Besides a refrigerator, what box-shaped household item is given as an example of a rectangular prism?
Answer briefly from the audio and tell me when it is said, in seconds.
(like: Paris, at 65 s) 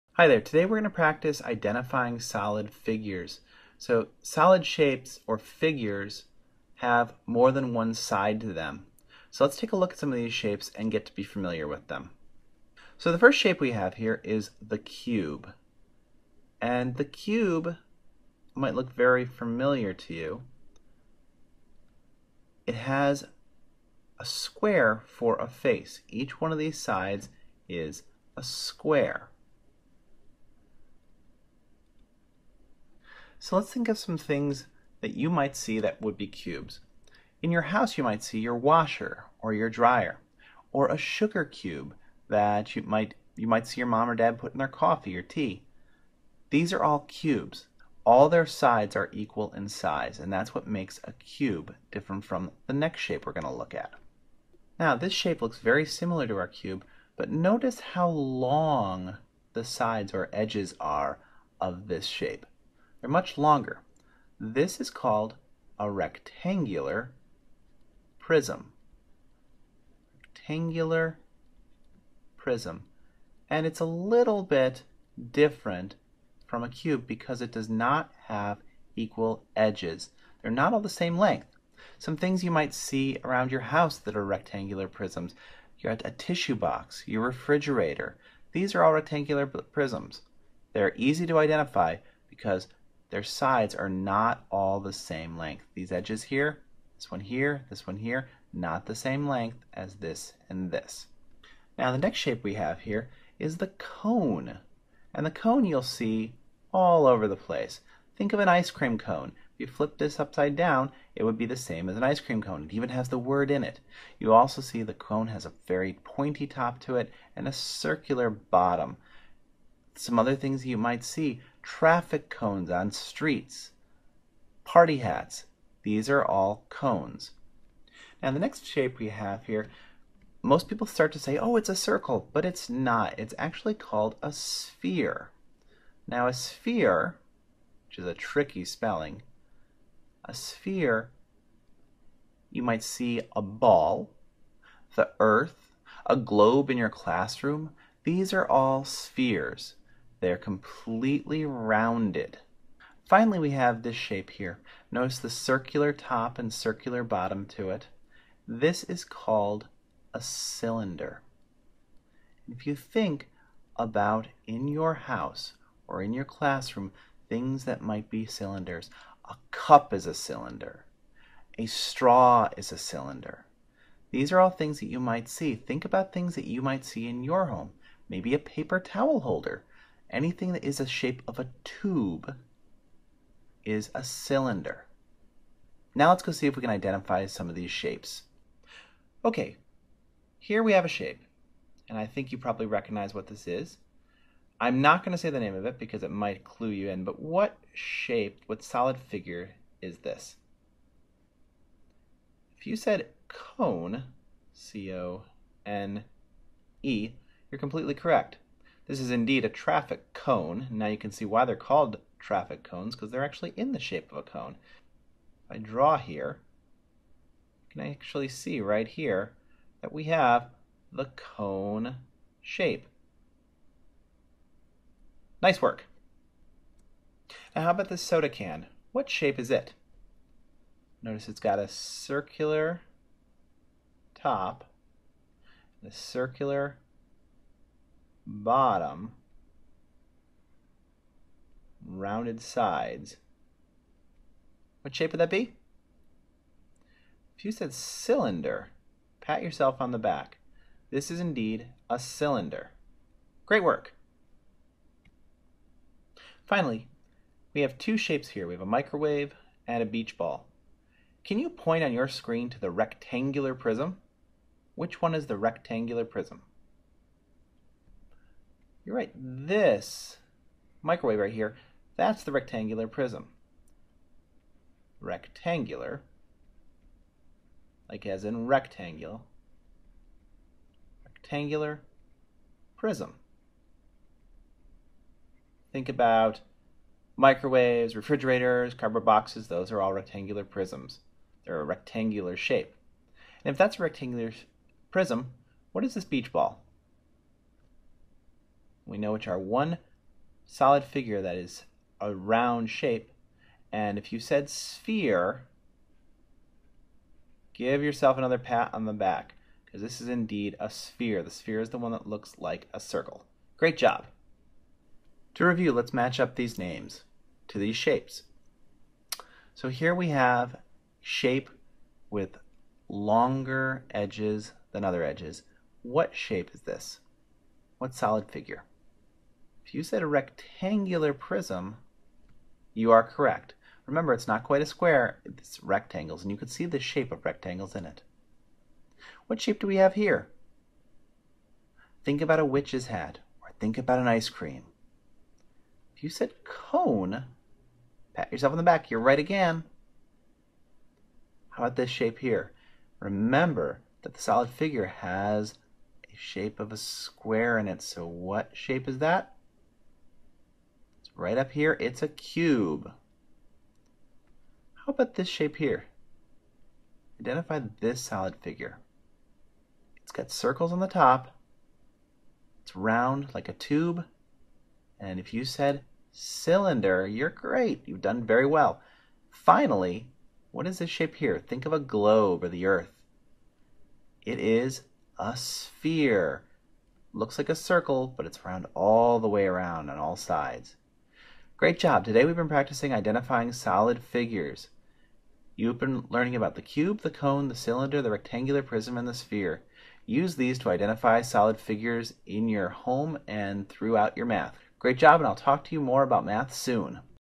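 Tissue box, at 85 s.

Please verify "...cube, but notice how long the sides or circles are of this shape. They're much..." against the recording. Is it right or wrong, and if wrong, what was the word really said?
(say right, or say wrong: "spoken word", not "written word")
wrong: "edges", not "circles".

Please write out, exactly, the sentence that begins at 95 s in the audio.
These edges here, this one here, this one here, not the same length as this and this.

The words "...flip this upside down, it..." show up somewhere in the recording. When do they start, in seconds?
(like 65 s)
109 s.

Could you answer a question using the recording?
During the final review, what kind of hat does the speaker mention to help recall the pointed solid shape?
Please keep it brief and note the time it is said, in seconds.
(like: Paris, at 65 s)
A witch's hat, at 342 s.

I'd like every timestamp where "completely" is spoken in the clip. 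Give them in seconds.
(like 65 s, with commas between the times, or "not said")
150 s, 207 s.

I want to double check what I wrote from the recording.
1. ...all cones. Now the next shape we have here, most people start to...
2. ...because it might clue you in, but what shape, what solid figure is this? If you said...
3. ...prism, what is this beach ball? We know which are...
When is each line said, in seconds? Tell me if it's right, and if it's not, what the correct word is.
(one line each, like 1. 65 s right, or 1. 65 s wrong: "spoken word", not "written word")
1. 126 s right
2. 195 s right
3. 294 s right.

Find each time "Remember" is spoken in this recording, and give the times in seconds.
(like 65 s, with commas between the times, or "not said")
333 s, 352 s.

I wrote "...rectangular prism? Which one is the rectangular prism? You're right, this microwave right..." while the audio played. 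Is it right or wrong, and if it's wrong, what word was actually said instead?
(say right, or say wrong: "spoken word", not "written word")
right.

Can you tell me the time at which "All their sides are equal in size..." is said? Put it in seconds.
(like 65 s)
48 s.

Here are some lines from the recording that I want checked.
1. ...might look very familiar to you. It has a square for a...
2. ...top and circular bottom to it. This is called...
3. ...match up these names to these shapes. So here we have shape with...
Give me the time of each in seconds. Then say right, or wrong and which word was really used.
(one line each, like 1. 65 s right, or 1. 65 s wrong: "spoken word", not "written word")
1. 18 s right
2. 155 s right
3. 315 s right.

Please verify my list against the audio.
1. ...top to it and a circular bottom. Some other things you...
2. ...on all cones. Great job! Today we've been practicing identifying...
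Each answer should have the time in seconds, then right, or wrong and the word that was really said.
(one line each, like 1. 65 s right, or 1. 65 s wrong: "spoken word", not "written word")
1. 116 s right
2. 389 s wrong: "sides", not "cones".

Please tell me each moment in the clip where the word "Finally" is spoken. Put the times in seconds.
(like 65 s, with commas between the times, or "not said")
153 s, 256 s, 379 s.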